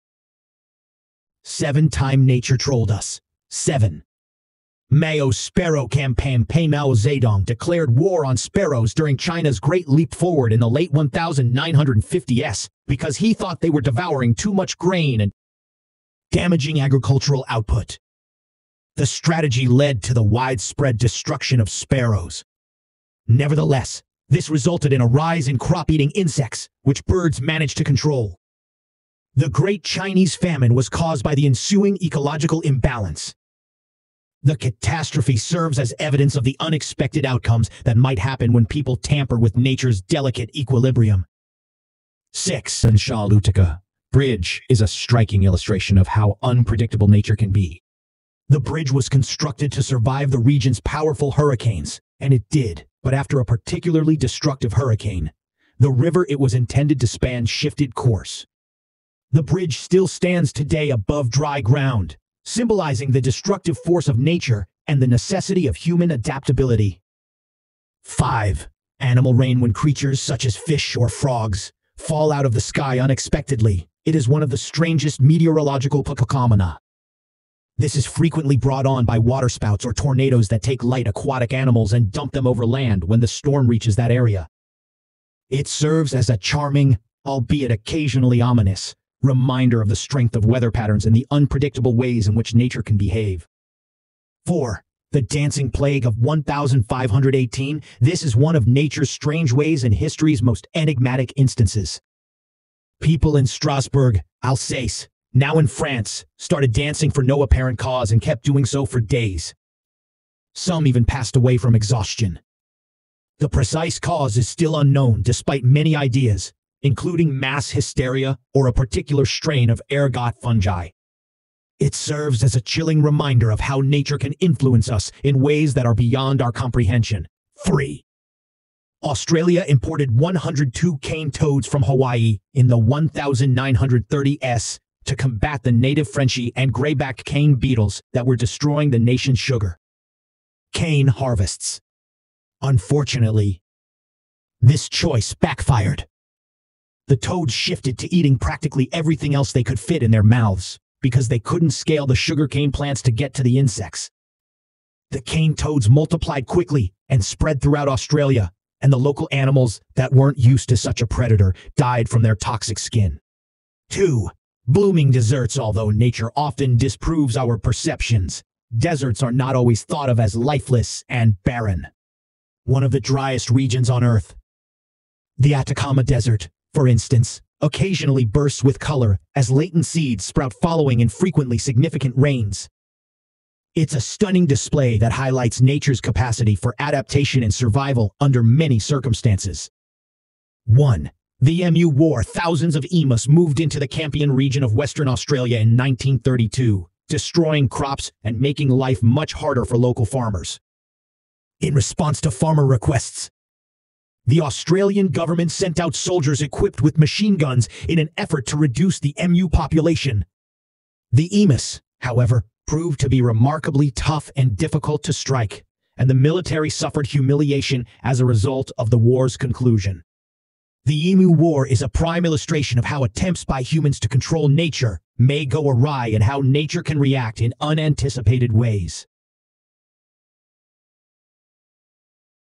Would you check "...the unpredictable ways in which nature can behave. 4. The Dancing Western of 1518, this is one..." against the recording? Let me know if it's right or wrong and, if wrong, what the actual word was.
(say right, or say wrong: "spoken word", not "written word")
wrong: "Plague", not "Western".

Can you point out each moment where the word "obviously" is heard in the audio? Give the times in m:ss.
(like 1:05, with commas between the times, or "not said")
not said.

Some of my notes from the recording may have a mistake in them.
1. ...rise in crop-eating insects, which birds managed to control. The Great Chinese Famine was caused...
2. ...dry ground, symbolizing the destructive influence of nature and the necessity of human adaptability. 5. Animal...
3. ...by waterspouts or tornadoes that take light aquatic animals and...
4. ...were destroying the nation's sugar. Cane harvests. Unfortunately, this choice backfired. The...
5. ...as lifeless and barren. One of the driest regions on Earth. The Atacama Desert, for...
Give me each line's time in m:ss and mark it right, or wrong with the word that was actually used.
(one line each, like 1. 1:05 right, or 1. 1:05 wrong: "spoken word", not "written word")
1. 0:25 right
2. 1:01 wrong: "force", not "influence"
3. 1:19 right
4. 2:18 right
5. 2:50 right.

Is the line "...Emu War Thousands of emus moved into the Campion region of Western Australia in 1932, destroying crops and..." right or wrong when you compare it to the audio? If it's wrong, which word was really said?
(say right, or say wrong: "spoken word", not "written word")
right.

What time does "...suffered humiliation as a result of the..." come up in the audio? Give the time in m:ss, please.
3:36.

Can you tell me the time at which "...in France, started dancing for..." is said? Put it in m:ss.
1:45.